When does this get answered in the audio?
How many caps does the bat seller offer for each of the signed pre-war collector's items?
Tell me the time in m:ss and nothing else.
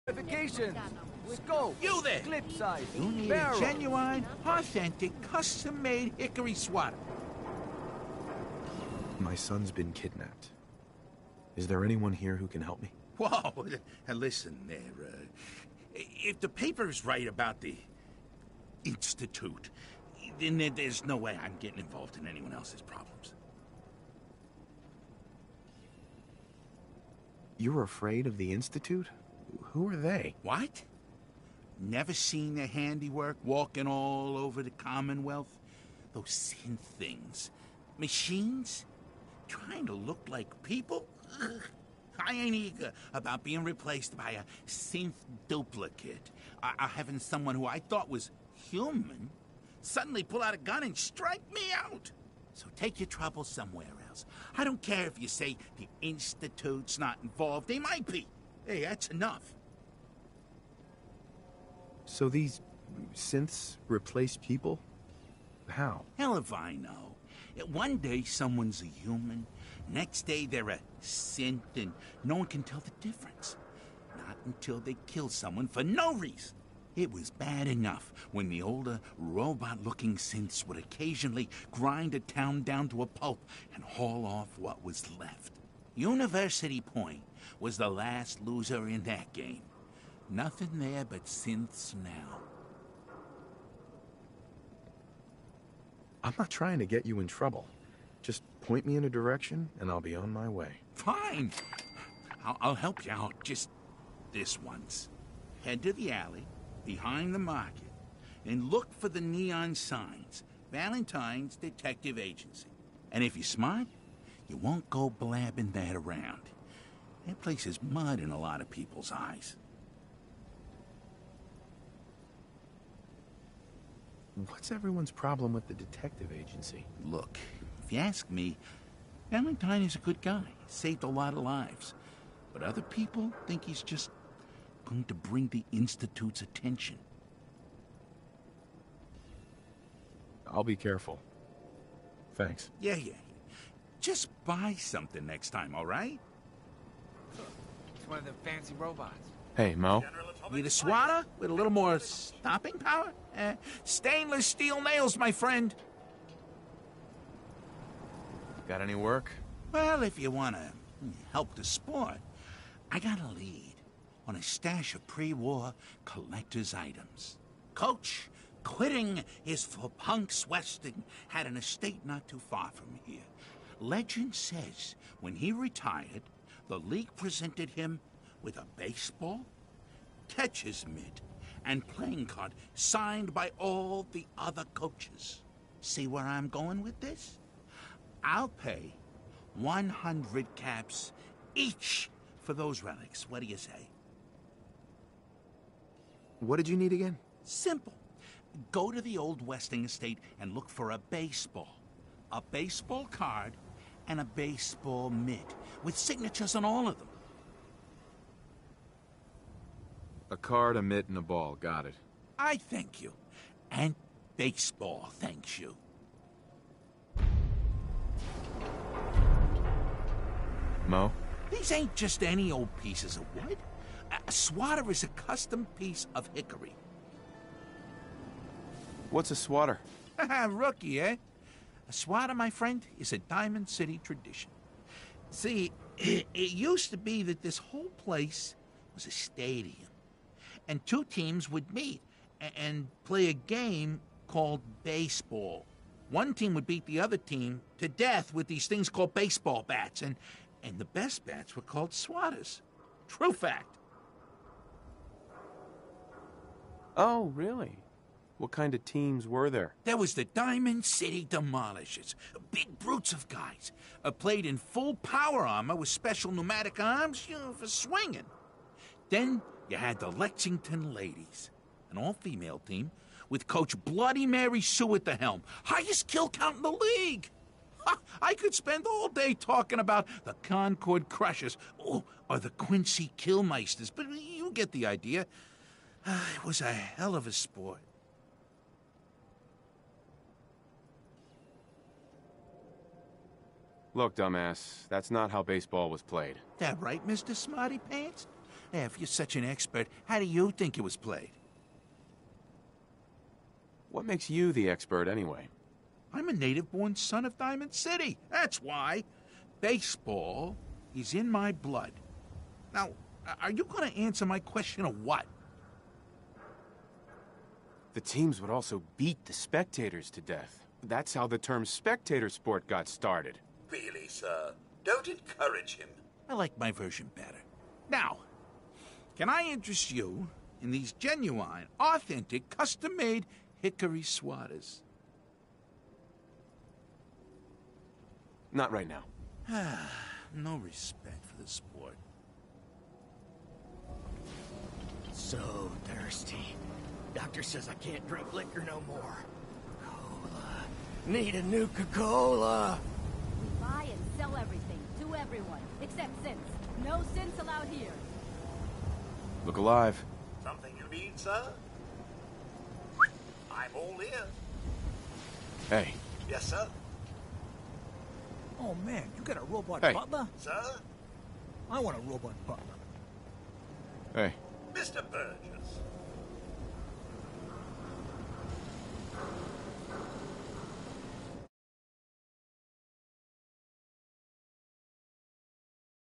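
3:09.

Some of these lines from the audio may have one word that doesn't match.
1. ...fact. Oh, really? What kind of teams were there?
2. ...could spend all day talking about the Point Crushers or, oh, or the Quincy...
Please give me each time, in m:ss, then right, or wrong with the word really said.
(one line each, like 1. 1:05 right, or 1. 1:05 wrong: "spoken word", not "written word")
1. 4:13 right
2. 4:38 wrong: "Concord", not "Point".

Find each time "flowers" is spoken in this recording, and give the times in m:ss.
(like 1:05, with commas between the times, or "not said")
not said.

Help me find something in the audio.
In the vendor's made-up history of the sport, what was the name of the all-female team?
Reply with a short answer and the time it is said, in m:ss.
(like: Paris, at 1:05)
Lexington Ladies, at 4:30.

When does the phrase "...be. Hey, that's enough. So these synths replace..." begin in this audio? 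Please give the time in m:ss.
0:58.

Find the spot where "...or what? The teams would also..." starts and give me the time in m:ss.
5:14.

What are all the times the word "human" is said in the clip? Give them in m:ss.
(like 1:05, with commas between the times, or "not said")
0:48, 1:08.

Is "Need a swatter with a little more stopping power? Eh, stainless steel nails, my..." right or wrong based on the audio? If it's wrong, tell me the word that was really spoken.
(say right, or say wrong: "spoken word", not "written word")
right.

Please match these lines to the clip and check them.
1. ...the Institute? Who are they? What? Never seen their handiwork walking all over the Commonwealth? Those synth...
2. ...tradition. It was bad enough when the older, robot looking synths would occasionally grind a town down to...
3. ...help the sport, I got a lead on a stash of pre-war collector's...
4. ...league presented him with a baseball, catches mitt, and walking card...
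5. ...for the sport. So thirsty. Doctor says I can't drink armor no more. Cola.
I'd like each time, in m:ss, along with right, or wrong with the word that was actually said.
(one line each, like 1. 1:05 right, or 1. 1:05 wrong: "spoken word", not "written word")
1. 0:28 right
2. 1:16 wrong: "reason", not "tradition"
3. 2:41 right
4. 2:56 wrong: "playing", not "walking"
5. 5:41 wrong: "liquor", not "armor".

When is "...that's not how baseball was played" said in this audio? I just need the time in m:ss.
4:54.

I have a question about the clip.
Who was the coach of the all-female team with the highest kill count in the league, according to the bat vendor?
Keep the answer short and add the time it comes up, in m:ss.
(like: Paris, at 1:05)
Bloody Mary Sue, at 4:33.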